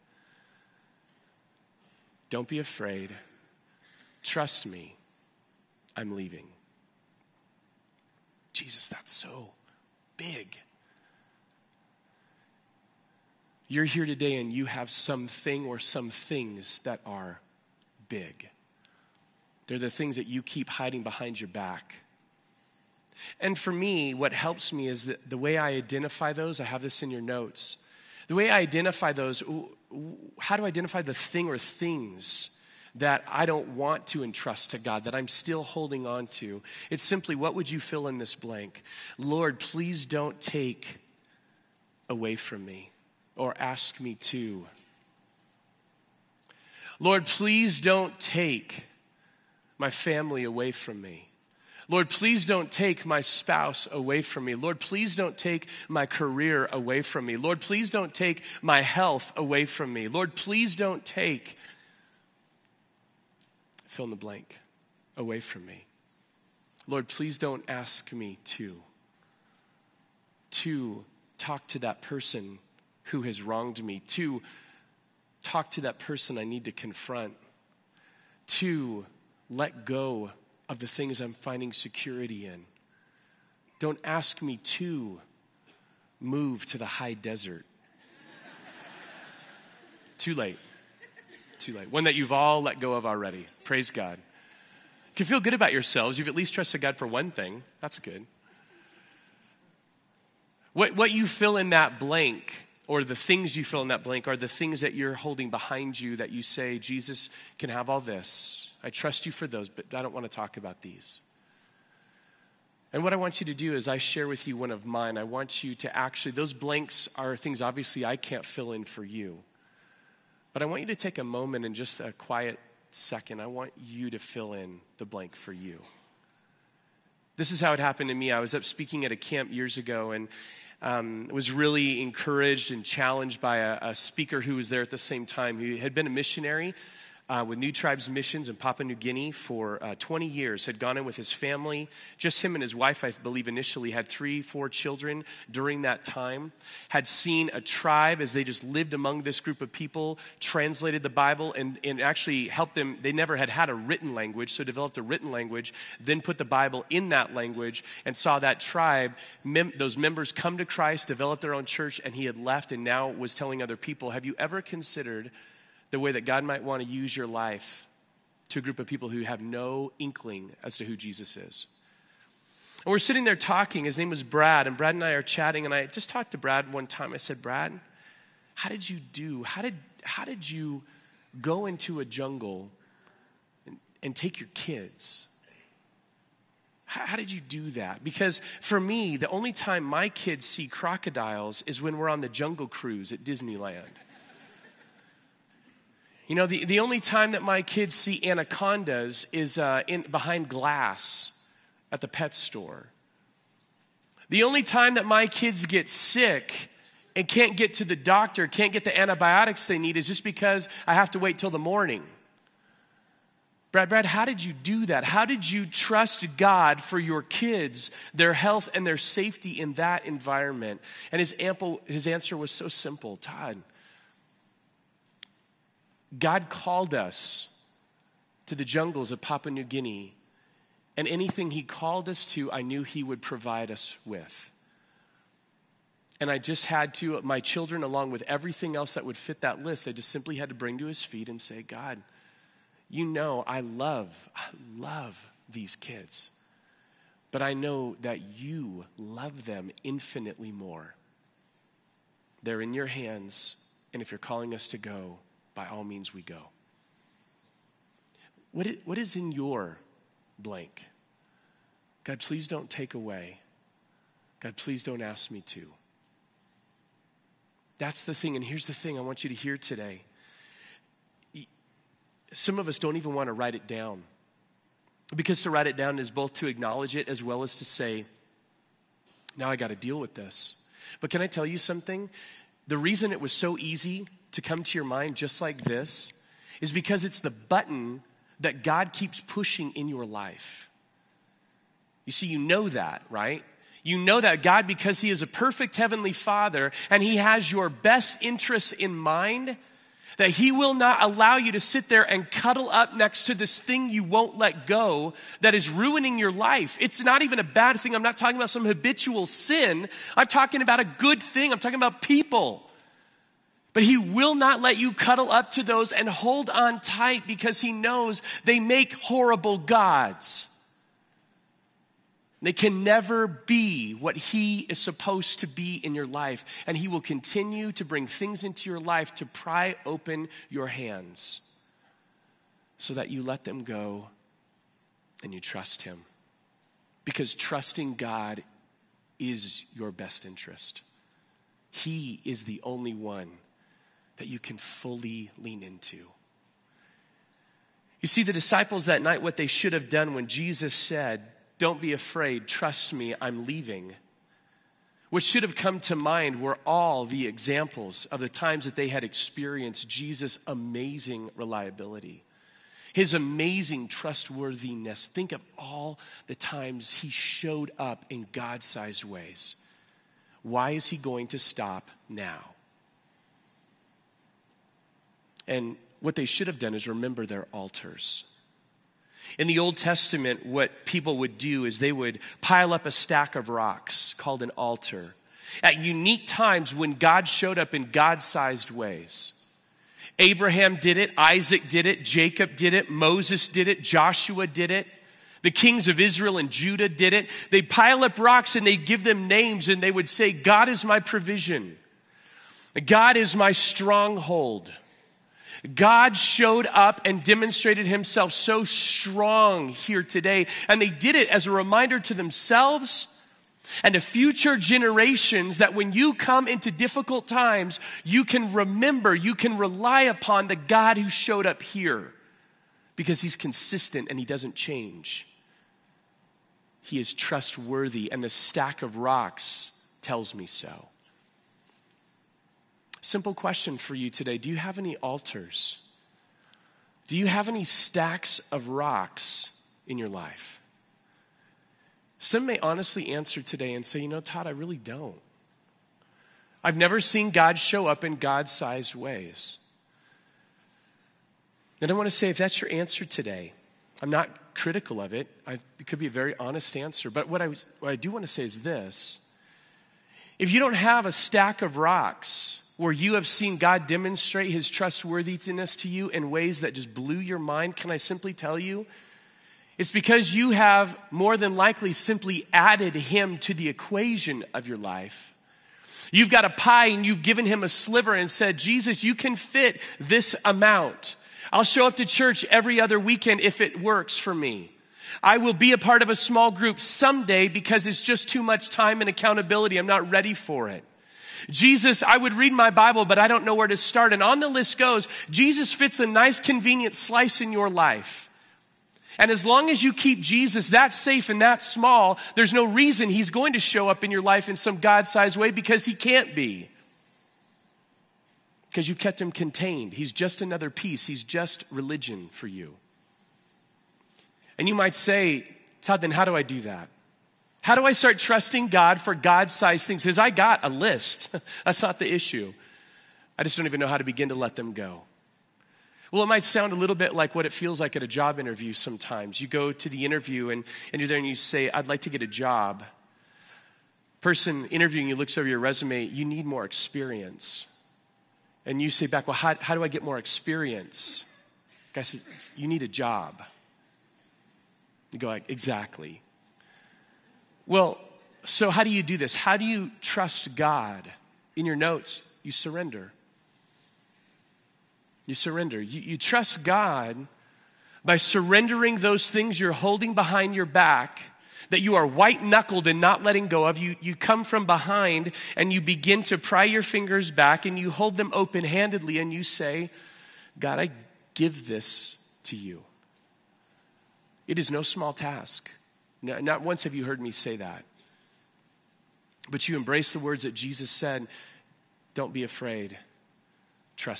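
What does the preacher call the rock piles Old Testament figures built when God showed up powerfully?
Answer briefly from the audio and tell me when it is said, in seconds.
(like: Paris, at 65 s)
altar, at 384 s.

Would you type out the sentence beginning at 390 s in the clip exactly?
Abraham did it, Isaac did it, Jacob did it, Moses did it, Joshua did it.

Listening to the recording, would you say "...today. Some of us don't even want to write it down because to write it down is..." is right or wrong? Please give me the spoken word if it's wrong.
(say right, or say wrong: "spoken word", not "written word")
right.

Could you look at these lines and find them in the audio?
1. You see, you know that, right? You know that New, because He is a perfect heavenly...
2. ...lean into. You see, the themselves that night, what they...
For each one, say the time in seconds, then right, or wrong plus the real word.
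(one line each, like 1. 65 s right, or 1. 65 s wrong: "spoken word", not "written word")
1. 292 s wrong: "God", not "New"
2. 345 s wrong: "disciples", not "themselves".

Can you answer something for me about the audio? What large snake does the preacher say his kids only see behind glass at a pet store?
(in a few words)
anacondas.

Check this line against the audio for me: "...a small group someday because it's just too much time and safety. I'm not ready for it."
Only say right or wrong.
wrong.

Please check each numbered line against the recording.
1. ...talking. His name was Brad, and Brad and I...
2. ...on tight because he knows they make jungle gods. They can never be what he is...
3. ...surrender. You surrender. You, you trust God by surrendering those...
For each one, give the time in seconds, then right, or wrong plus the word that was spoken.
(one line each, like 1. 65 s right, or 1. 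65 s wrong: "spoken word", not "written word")
1. 173 s right
2. 316 s wrong: "horrible", not "jungle"
3. 552 s right.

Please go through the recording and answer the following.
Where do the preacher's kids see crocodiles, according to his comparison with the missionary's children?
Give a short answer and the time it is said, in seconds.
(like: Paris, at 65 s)
Disneyland, at 193 s.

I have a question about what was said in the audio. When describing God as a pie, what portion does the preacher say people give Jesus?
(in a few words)
a sliver.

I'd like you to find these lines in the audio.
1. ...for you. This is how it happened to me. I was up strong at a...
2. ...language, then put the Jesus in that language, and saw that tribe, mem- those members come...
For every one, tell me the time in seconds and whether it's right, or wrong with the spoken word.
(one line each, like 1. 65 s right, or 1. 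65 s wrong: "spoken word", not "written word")
1. 125 s wrong: "speaking", not "strong"
2. 155 s wrong: "Bible", not "Jesus".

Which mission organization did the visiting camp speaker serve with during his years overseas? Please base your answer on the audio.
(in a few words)
New Tribes Missions.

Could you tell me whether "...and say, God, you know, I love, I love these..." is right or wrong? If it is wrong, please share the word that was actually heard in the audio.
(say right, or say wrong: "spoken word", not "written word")
right.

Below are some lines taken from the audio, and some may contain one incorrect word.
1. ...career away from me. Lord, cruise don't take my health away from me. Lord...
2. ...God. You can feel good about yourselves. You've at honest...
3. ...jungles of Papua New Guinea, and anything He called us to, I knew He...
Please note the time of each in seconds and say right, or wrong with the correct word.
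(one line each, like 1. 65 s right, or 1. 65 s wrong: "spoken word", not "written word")
1. 56 s wrong: "please", not "cruise"
2. 93 s wrong: "least", not "honest"
3. 228 s right.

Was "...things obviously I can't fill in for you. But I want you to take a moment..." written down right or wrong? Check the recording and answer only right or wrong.
right.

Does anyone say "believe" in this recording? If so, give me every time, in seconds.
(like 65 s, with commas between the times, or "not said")
143 s.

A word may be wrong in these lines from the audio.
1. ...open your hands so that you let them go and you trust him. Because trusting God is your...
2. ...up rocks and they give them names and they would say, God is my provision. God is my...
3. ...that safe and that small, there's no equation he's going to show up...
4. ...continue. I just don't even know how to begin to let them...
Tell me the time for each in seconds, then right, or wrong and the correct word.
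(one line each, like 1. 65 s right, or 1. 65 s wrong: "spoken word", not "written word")
1. 329 s right
2. 398 s right
3. 500 s wrong: "reason", not "equation"
4. 522 s wrong: "issue", not "continue".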